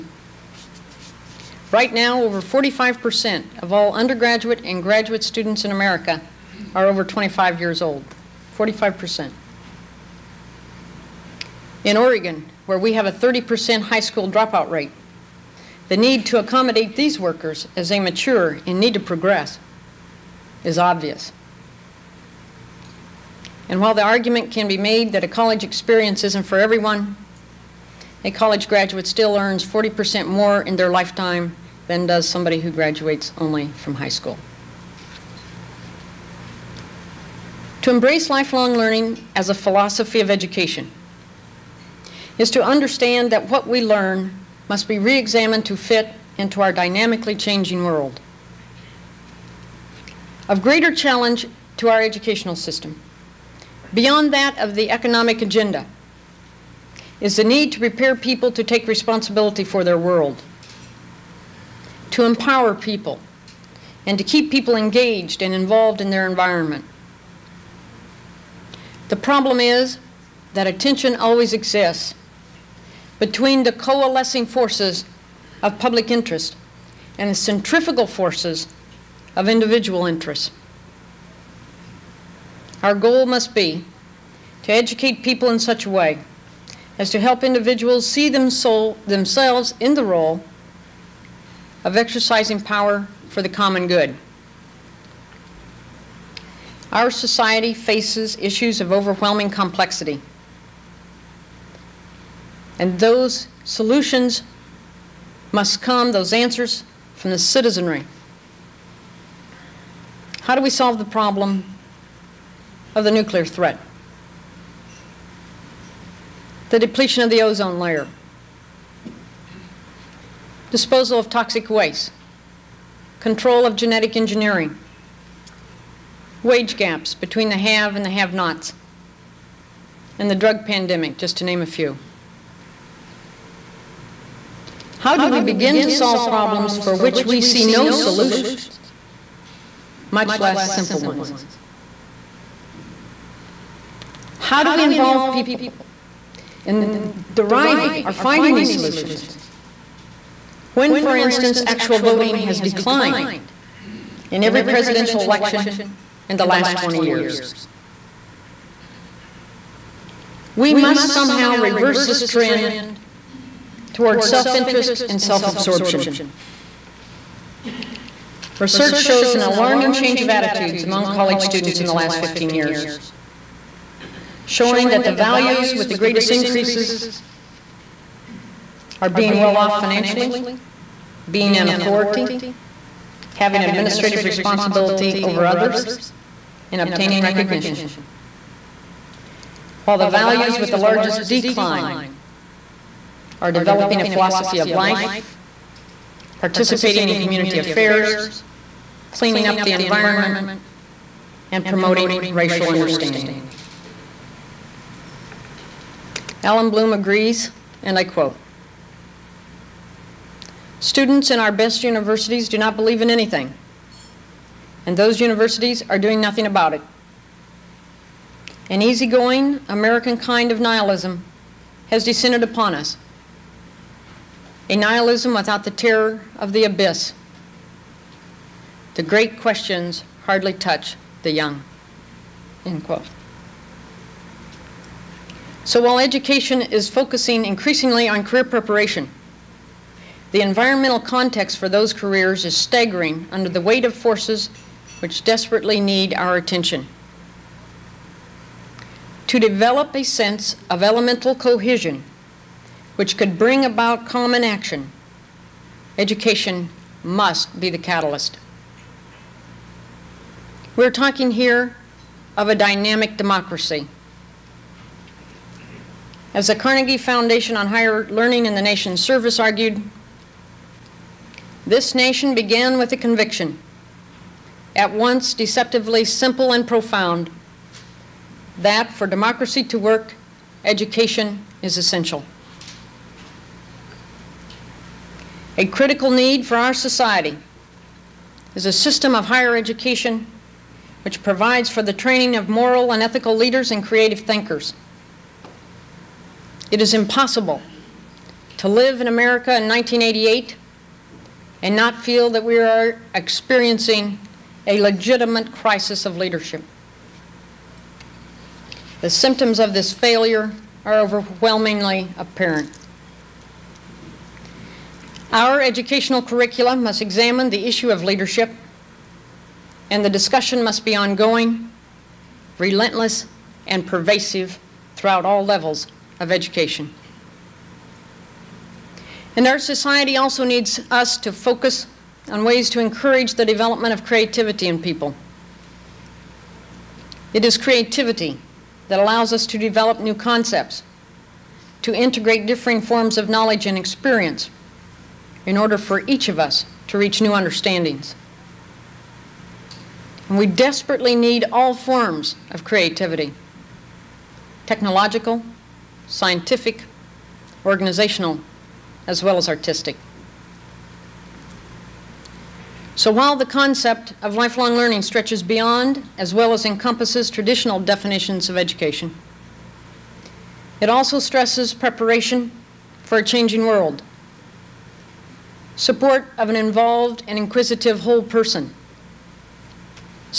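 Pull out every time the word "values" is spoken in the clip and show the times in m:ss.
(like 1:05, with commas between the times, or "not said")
2:55, 3:10.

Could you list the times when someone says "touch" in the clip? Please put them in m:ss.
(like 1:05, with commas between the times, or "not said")
3:50.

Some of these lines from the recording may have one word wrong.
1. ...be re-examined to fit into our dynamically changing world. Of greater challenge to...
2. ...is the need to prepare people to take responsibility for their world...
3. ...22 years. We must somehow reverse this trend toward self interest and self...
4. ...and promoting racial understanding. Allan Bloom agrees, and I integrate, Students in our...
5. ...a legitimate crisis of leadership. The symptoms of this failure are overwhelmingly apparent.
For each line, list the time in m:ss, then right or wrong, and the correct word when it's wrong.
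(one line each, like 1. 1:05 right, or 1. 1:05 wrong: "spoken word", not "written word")
1. 0:44 right
2. 0:57 right
3. 2:36 wrong: "20", not "22"
4. 3:21 wrong: "quote", not "integrate"
5. 5:04 right.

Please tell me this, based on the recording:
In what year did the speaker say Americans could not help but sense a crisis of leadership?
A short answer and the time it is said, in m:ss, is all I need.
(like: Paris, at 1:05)
1988, at 4:59.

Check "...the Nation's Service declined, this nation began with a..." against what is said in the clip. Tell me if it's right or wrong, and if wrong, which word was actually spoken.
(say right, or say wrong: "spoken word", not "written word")
wrong: "argued", not "declined".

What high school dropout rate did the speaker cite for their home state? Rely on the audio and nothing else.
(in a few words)
30%.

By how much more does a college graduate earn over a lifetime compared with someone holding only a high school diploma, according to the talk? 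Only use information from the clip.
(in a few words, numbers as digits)
40%.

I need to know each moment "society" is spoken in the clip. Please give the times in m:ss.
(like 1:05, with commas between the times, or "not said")
1:37, 4:46, 5:29.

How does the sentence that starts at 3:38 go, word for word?
An easygoing, American kind of nihilism has descended upon us.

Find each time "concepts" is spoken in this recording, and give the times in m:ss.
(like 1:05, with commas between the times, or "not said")
5:40, 6:03.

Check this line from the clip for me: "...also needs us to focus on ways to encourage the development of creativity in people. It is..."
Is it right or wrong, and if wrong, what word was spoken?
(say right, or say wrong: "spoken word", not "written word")
right.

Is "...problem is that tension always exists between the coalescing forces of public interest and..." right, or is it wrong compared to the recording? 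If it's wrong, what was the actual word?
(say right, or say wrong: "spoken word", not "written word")
right.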